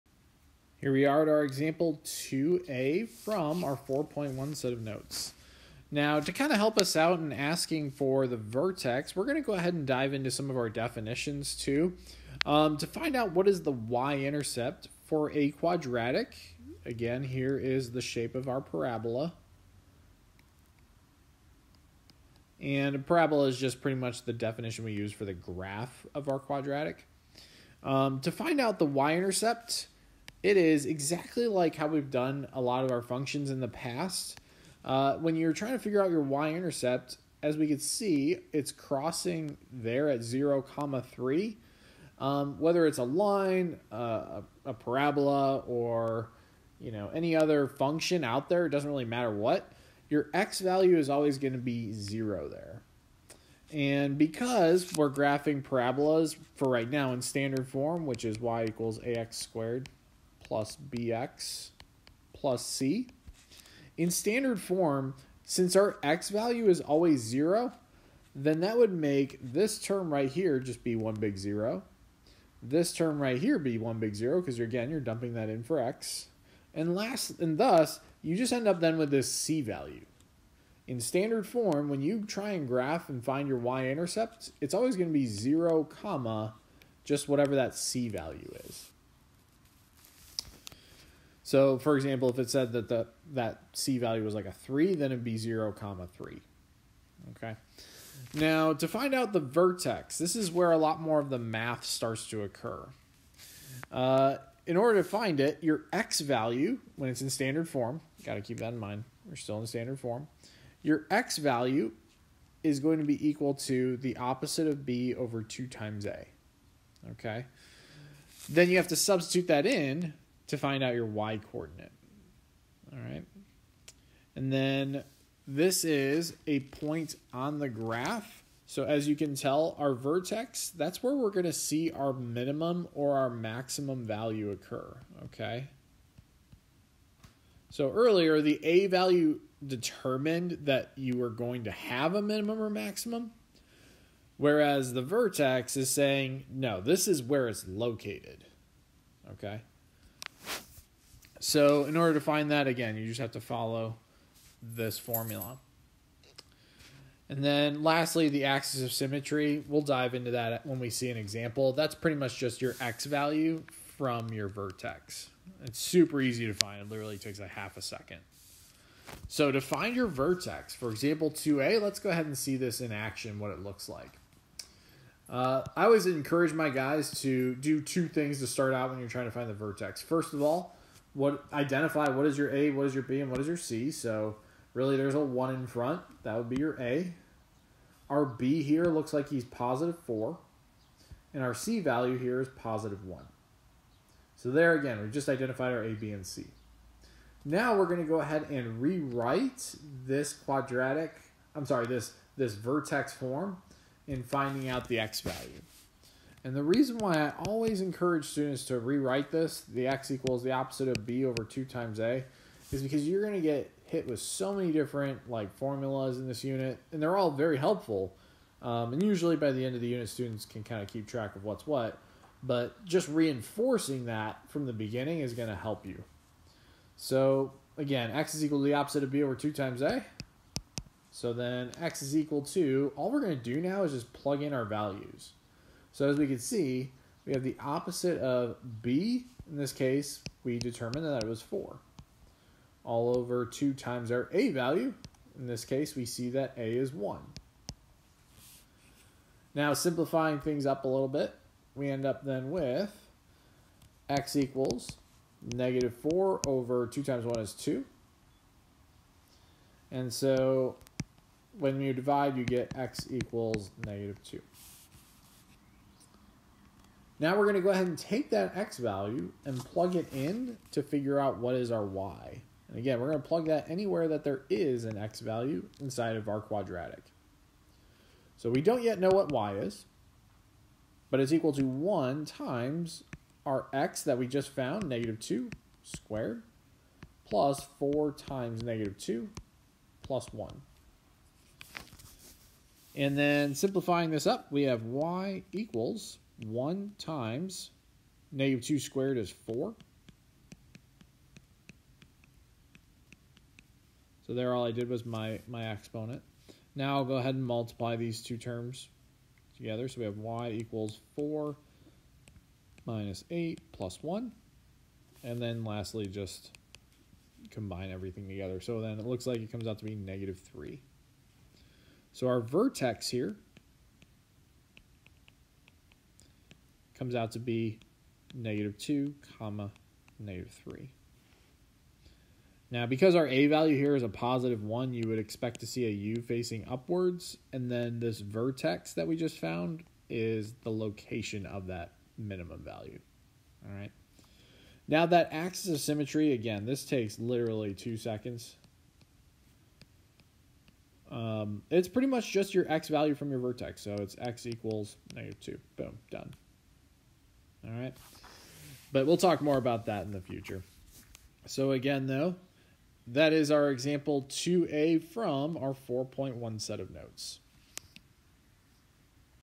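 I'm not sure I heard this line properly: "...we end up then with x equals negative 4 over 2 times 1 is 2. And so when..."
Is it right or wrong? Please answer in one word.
right.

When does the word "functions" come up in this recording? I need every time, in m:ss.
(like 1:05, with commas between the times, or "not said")
0:33, 0:47.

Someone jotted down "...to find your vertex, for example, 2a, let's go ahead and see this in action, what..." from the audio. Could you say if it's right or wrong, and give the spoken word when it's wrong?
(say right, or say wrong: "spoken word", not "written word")
right.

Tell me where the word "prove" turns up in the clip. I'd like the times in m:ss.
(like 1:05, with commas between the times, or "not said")
not said.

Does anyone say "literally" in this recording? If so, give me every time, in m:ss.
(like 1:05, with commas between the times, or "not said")
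2:46, 5:47.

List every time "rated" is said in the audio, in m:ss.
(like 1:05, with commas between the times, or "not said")
not said.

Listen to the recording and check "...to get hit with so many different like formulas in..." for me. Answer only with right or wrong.
right.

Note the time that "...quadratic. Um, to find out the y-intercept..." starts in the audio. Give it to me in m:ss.
0:26.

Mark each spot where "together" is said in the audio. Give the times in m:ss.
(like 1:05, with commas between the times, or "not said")
5:09, 5:18.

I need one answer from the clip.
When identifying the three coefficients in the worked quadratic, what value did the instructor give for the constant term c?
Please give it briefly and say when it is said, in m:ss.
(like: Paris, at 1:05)
positive 1, at 3:12.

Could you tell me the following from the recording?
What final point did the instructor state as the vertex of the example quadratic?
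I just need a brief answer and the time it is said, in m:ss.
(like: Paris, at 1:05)
(-2, -3), at 5:28.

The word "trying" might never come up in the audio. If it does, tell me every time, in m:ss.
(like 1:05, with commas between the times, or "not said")
0:35, 2:59.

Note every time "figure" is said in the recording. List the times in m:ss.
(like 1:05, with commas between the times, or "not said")
0:35, 4:30.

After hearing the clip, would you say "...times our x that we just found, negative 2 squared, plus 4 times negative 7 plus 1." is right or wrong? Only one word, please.
wrong.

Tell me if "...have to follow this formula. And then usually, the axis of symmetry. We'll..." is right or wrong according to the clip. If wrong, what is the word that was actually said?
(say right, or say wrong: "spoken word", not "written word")
wrong: "lastly", not "usually".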